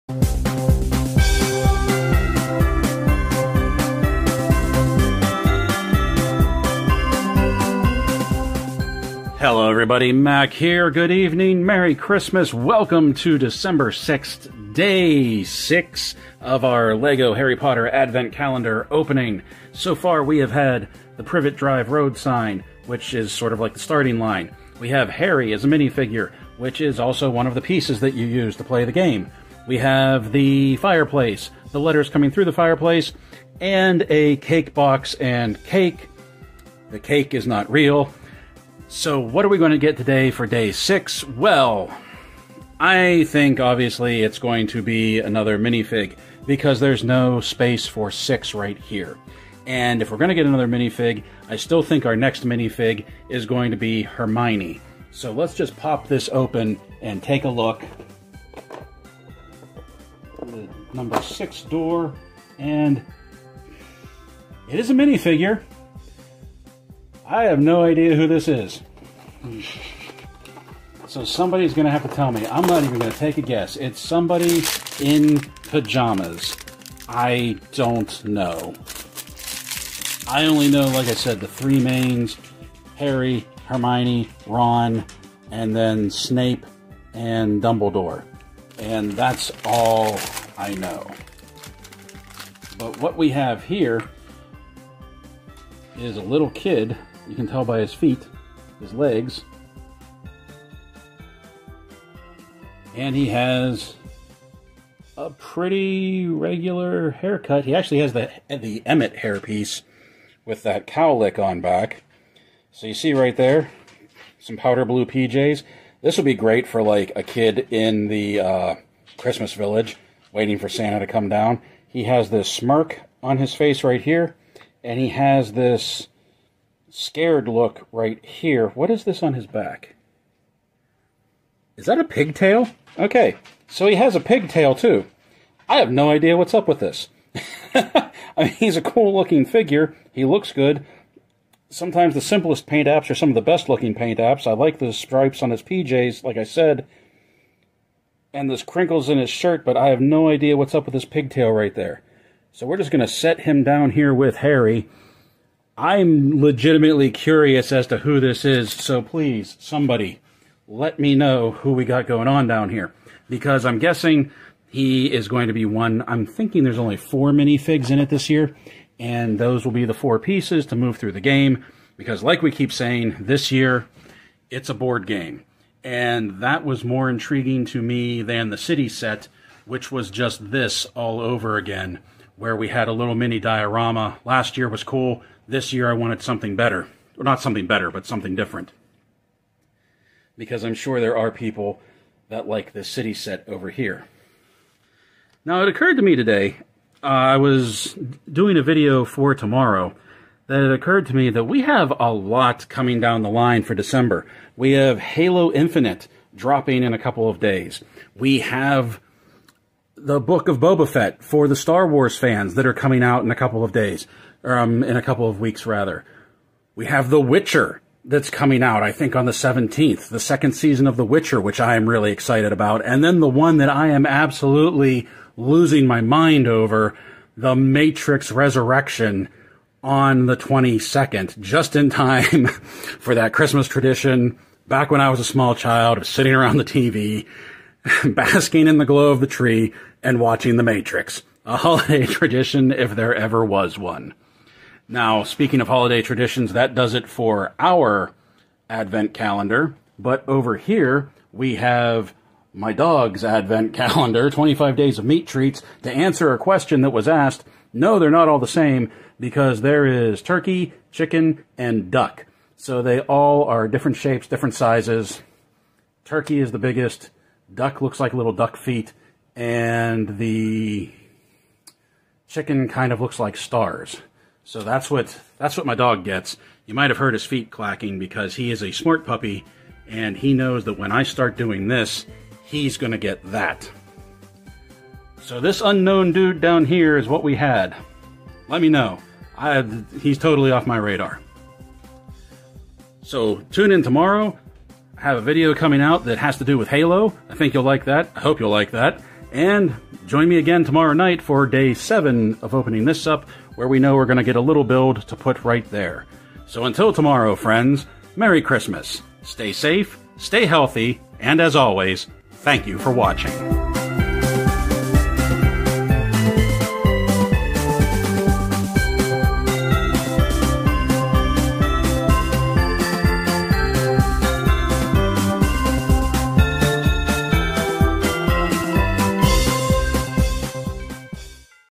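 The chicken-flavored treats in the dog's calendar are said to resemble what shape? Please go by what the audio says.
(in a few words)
Stars.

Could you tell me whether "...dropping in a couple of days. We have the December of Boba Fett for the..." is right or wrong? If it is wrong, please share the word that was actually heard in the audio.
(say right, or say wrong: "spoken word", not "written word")
wrong: "Book", not "December".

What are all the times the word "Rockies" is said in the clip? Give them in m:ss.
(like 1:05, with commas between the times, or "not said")
not said.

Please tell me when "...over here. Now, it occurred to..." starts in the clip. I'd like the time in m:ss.
3:13.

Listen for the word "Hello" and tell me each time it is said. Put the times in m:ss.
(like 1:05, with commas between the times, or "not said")
0:09.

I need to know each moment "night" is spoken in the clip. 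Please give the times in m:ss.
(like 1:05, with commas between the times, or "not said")
5:00.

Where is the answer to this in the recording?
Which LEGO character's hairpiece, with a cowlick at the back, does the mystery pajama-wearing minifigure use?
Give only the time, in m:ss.
1:48.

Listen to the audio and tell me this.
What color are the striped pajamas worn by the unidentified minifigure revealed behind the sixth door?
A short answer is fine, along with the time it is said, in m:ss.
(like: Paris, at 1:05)
Powder blue, at 1:54.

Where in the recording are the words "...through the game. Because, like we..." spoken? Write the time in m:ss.
2:50.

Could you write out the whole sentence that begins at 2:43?
Because I'm guessing he is going to be one.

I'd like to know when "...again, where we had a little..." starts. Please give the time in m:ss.
3:01.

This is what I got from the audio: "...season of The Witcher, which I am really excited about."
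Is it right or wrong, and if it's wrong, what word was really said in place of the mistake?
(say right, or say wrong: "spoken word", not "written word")
right.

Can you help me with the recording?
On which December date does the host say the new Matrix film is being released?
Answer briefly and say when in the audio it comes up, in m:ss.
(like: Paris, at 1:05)
22nd, at 3:50.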